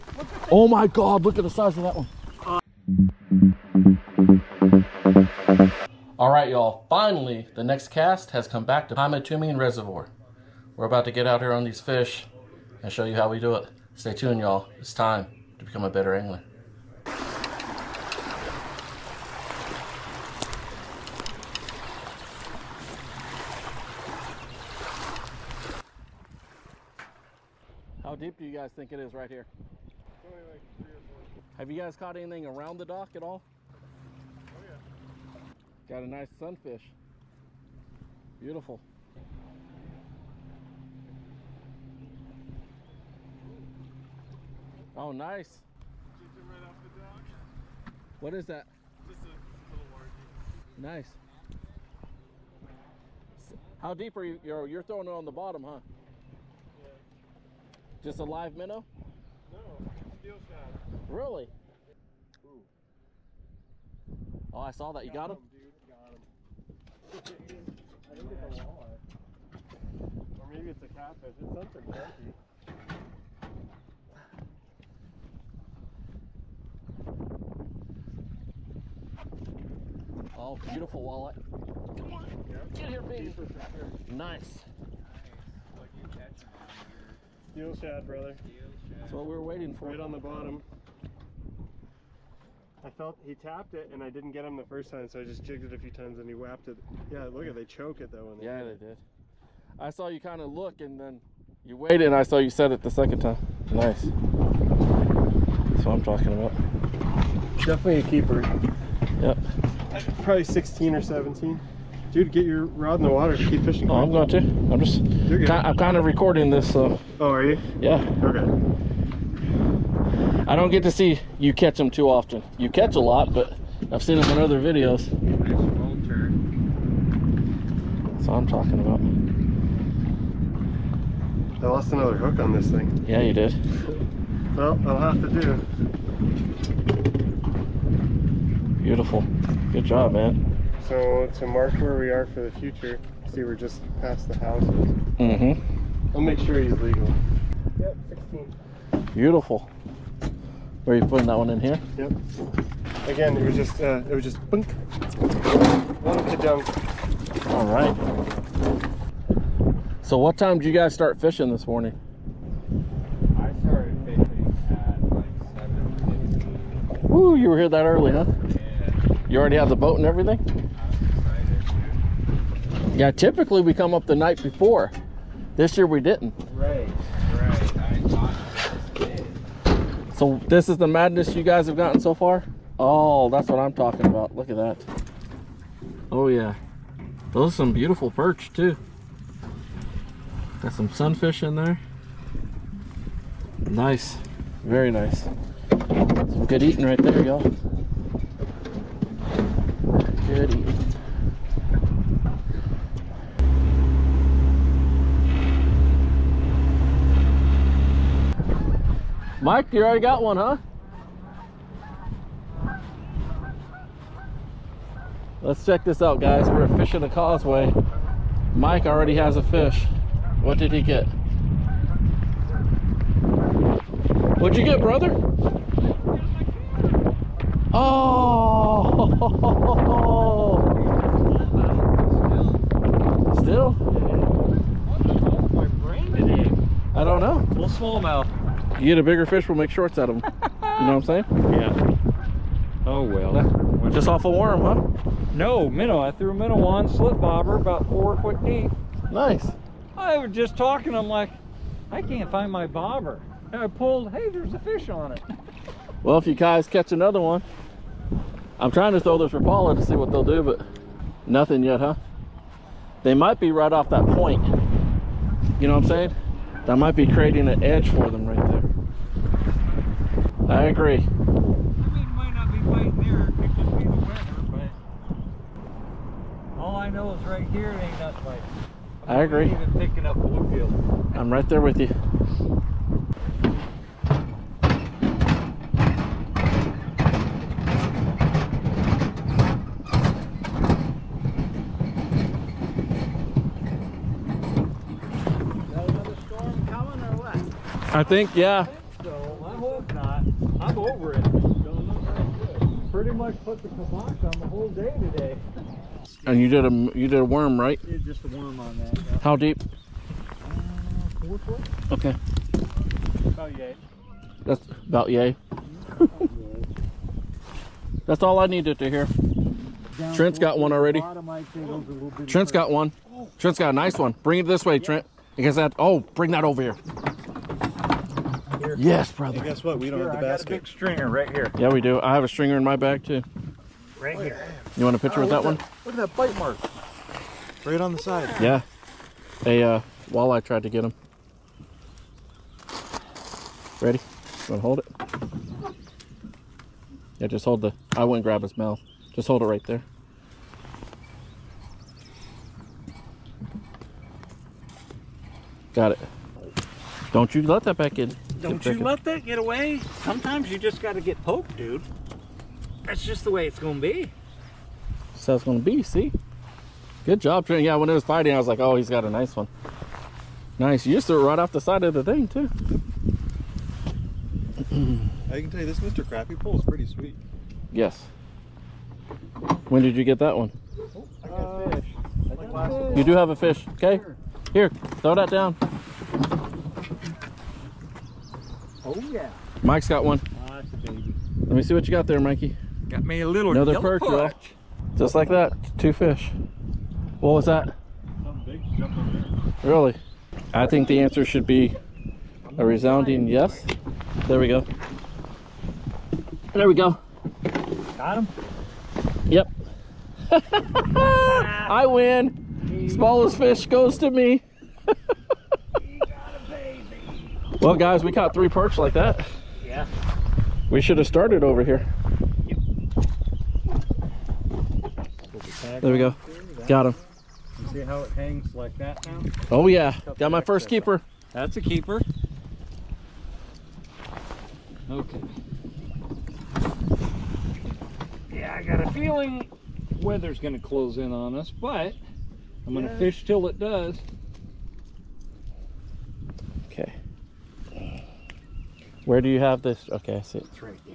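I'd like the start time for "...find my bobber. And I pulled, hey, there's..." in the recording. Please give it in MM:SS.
04:12.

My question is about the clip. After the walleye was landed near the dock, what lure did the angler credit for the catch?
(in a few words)
Steel shad.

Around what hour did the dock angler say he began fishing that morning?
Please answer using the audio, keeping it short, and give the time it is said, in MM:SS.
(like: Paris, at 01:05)
7, at 02:45.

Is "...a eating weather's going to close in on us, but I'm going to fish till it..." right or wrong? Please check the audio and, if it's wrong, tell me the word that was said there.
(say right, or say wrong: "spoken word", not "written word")
wrong: "feeling", not "eating".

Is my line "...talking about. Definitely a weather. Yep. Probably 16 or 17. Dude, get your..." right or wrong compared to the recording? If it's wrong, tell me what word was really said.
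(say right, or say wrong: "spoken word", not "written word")
wrong: "keeper", not "weather".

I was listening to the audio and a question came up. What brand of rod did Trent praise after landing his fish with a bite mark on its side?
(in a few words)
Mr. Crappie.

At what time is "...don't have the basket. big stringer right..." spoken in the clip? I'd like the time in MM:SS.
05:29.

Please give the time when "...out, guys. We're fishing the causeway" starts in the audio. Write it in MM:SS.
03:36.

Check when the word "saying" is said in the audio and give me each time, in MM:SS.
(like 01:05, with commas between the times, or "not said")
04:01, 04:25.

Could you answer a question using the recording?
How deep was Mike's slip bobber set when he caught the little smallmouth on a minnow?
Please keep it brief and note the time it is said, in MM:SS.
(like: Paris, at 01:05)
4 feet, at 04:07.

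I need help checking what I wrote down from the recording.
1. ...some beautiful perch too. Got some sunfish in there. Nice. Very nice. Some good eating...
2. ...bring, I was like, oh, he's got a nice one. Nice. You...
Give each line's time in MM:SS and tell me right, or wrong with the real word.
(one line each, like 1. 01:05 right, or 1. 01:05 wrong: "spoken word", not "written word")
1. 03:07 right
2. 06:08 wrong: "fighting", not "bring".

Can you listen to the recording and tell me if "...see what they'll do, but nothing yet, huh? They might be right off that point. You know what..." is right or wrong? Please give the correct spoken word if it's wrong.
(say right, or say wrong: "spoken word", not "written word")
right.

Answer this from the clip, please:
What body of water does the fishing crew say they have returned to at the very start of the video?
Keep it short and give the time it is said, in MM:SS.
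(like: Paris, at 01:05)
Pymatuning Reservoir, at 00:08.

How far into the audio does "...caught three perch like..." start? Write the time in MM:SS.
06:58.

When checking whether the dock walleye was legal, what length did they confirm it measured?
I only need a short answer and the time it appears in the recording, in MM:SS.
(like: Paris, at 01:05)
16, at 02:27.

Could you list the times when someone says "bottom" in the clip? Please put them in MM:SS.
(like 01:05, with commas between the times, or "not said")
00:55, 01:30.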